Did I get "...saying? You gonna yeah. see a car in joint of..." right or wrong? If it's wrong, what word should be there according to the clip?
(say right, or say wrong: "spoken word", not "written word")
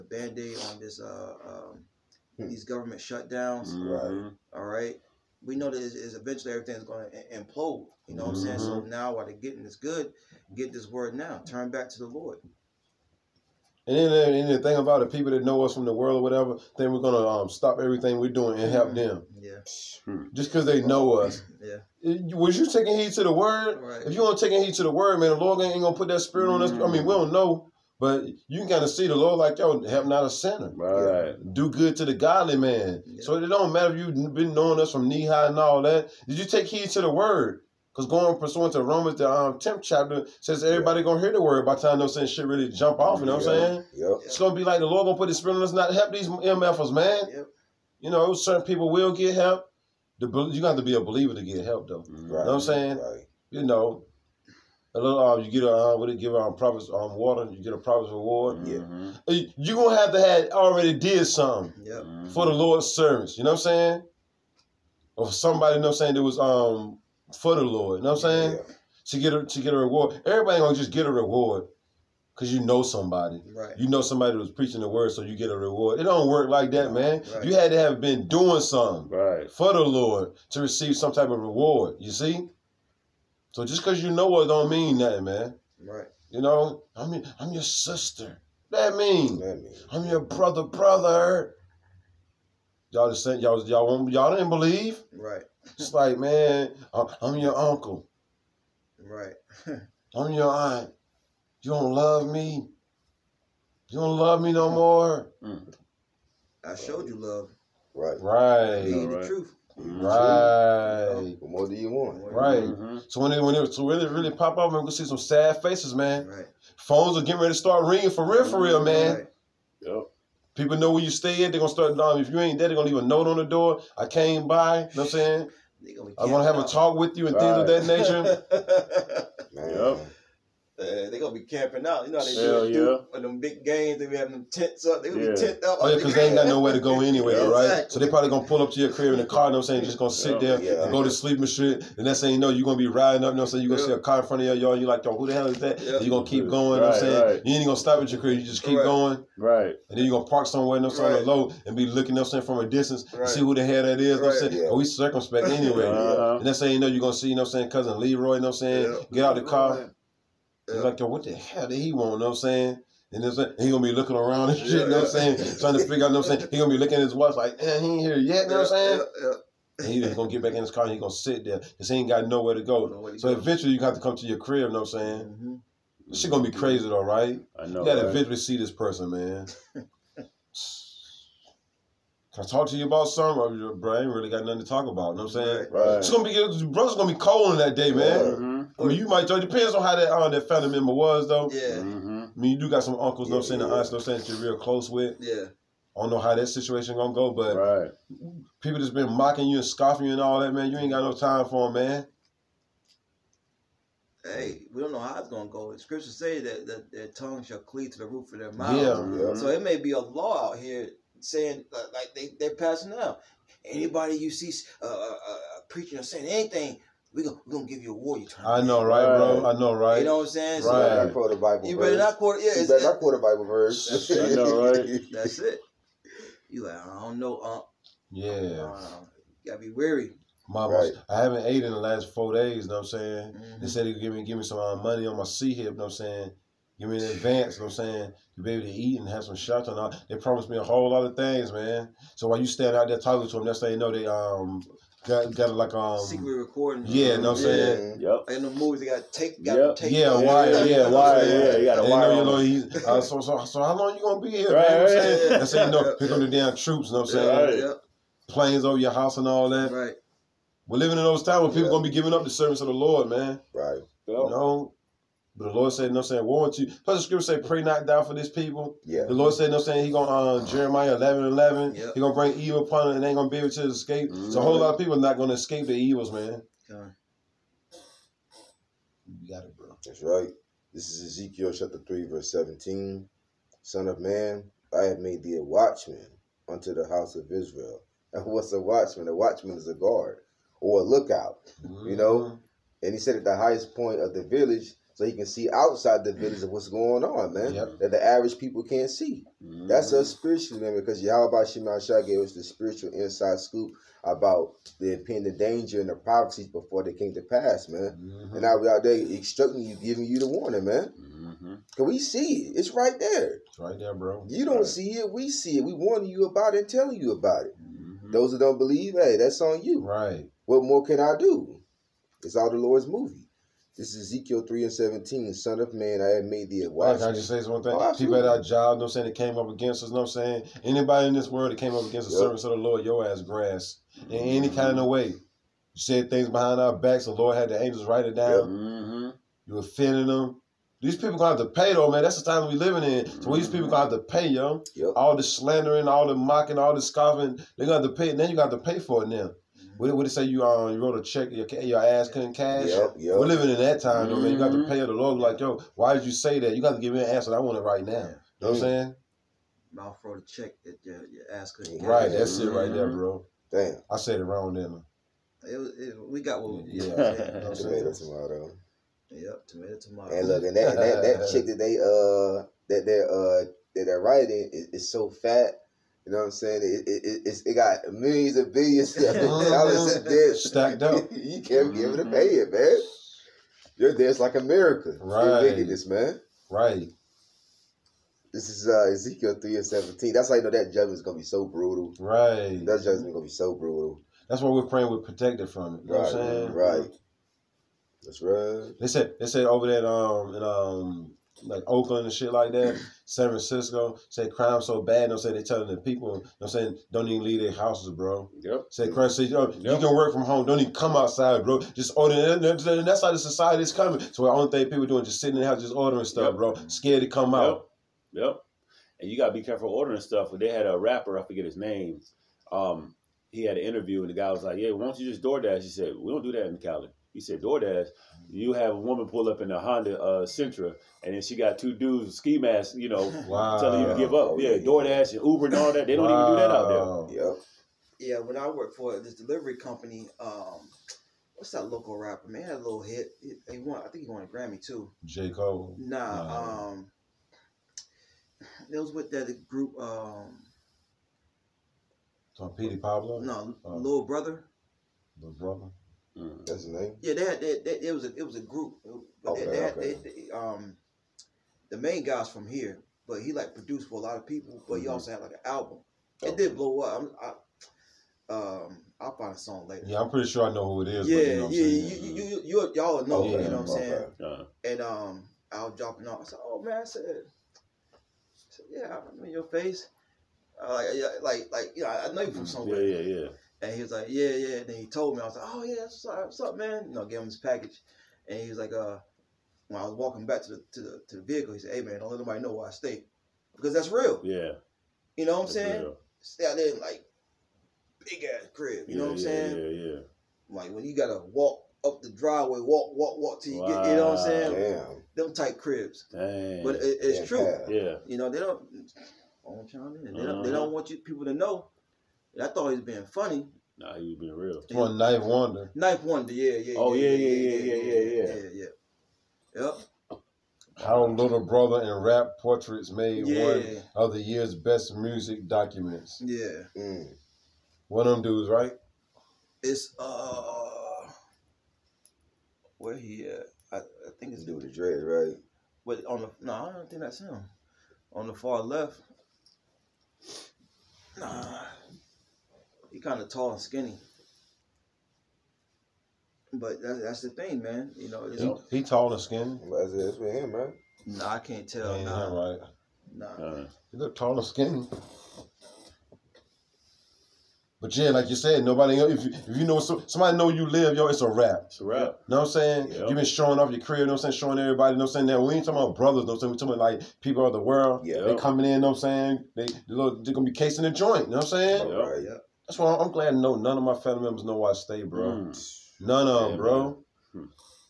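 wrong: "front", not "joint".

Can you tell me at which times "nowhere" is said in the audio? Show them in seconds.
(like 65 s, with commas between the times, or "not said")
136 s, 172 s.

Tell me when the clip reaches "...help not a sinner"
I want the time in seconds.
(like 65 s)
29 s.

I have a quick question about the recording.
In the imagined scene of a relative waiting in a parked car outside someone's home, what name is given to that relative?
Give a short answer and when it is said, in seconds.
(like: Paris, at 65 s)
Leroy, at 157 s.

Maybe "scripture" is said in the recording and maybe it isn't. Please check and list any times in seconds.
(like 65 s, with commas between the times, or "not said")
205 s, 267 s.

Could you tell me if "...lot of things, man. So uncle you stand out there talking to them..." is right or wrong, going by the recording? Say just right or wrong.
wrong.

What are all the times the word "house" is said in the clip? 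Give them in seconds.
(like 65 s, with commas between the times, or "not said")
258 s, 286 s, 407 s, 415 s.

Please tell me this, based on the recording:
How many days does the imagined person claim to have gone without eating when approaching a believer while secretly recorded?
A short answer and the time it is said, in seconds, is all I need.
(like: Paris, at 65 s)
4, at 232 s.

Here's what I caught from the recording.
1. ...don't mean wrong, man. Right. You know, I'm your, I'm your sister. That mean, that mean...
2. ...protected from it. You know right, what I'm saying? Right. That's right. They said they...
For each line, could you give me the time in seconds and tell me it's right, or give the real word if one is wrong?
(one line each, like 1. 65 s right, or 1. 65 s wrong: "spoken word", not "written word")
1. 84 s wrong: "nothing", not "wrong"
2. 394 s right.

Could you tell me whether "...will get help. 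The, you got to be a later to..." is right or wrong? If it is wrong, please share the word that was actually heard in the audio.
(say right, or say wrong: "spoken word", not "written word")
wrong: "believer", not "later".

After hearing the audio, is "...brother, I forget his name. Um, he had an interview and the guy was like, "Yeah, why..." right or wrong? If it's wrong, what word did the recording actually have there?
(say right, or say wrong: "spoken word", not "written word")
wrong: "rapper", not "brother".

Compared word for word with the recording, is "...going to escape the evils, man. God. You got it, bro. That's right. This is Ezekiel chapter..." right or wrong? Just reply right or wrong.
right.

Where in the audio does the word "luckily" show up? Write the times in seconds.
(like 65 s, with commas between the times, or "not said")
not said.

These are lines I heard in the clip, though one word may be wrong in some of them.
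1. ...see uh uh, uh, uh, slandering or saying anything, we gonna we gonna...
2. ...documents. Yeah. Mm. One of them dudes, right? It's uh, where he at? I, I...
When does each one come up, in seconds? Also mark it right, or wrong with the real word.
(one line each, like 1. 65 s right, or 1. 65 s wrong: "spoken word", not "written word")
1. 214 s wrong: "preaching", not "slandering"
2. 525 s right.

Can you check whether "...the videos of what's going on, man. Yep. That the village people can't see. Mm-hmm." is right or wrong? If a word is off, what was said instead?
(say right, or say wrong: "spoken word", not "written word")
wrong: "average", not "village".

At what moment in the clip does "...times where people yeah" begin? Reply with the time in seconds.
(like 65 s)
261 s.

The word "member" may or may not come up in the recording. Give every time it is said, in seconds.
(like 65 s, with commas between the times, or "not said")
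190 s, 574 s.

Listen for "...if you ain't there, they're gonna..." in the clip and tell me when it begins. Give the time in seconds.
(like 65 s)
122 s.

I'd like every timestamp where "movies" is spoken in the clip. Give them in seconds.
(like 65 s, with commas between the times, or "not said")
248 s, 322 s.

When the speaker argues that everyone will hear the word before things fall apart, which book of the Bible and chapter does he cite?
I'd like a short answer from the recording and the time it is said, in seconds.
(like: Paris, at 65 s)
Romans 10, at 38 s.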